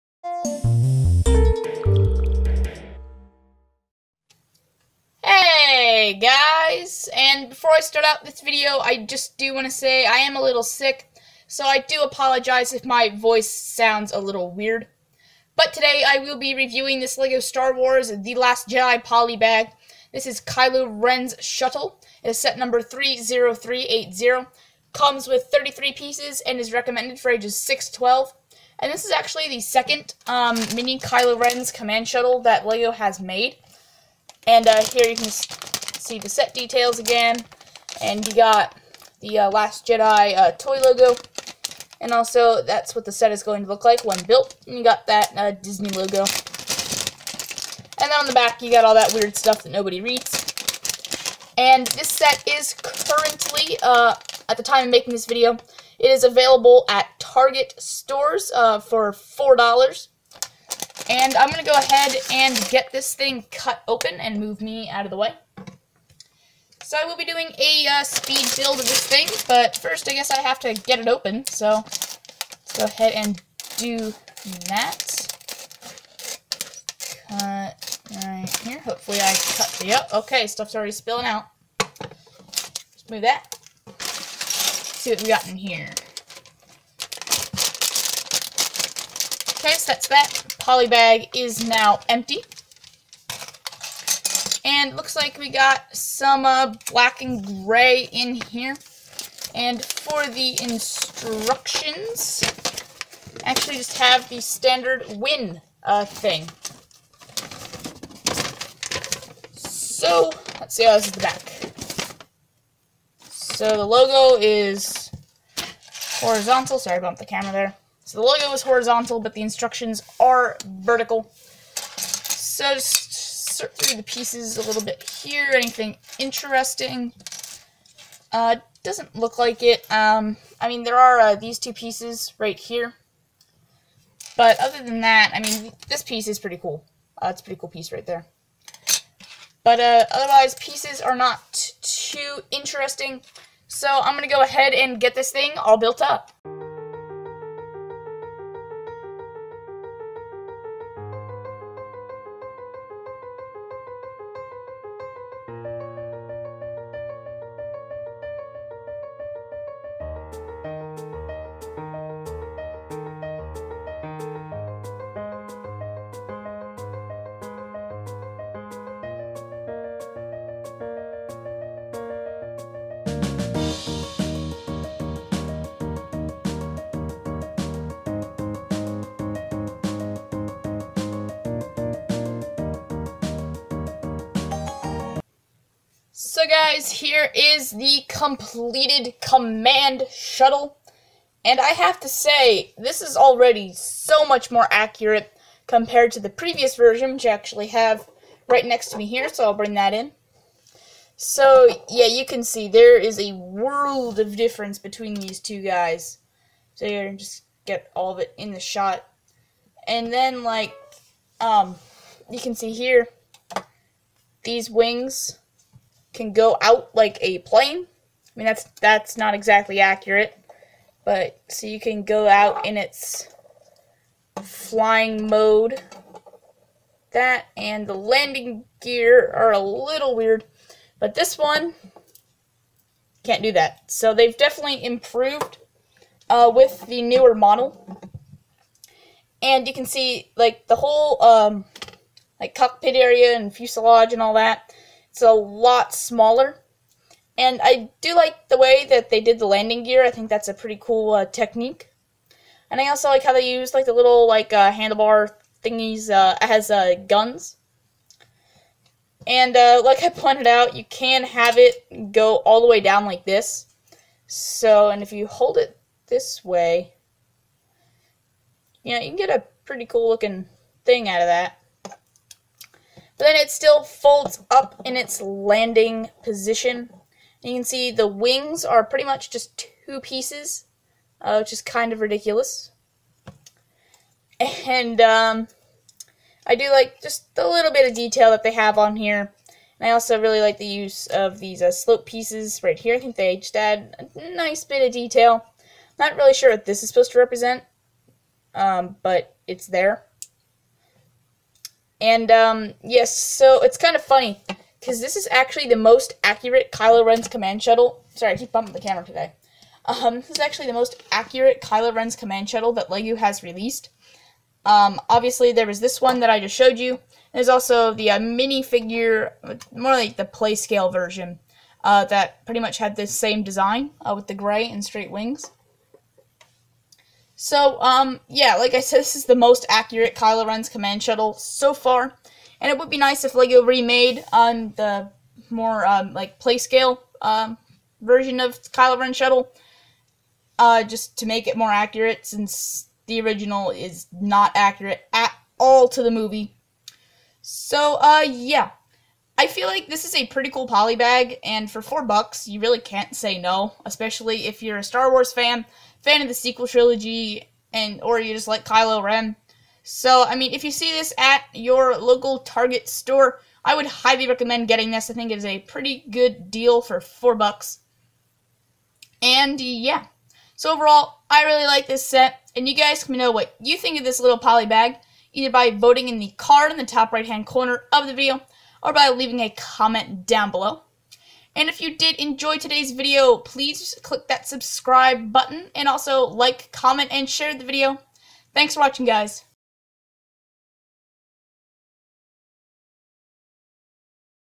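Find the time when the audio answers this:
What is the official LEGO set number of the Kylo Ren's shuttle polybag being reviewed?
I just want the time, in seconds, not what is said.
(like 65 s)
22 s.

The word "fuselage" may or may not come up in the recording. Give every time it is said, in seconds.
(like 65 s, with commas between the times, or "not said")
243 s.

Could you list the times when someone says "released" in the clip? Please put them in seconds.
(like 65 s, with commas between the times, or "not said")
313 s.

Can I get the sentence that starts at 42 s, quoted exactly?
And also, that's what the set is going to look like when built.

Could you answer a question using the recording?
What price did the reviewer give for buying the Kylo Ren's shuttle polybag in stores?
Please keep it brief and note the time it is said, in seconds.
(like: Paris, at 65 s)
$4, at 59 s.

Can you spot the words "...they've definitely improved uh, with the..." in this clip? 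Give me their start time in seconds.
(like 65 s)
234 s.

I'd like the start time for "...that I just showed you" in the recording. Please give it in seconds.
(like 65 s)
316 s.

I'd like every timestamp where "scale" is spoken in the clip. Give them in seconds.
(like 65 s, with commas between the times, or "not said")
320 s, 336 s.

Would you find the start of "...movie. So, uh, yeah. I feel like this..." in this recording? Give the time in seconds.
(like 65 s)
346 s.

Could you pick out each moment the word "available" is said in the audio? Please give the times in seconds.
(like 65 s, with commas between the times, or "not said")
56 s.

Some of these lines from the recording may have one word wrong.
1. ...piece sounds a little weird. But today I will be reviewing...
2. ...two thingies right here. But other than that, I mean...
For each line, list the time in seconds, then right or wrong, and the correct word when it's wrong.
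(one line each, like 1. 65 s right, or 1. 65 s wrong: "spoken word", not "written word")
1. 13 s wrong: "voice", not "piece"
2. 131 s wrong: "pieces", not "thingies".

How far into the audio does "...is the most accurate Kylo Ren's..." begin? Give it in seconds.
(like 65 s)
329 s.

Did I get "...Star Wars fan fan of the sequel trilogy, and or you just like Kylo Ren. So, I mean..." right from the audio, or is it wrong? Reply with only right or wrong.
right.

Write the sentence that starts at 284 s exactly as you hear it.
And um, I do like just a little bit of detail that they have on here.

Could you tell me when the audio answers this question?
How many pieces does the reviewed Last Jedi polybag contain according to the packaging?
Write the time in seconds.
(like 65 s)
25 s.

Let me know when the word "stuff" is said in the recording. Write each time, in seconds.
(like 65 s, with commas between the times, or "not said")
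49 s, 80 s.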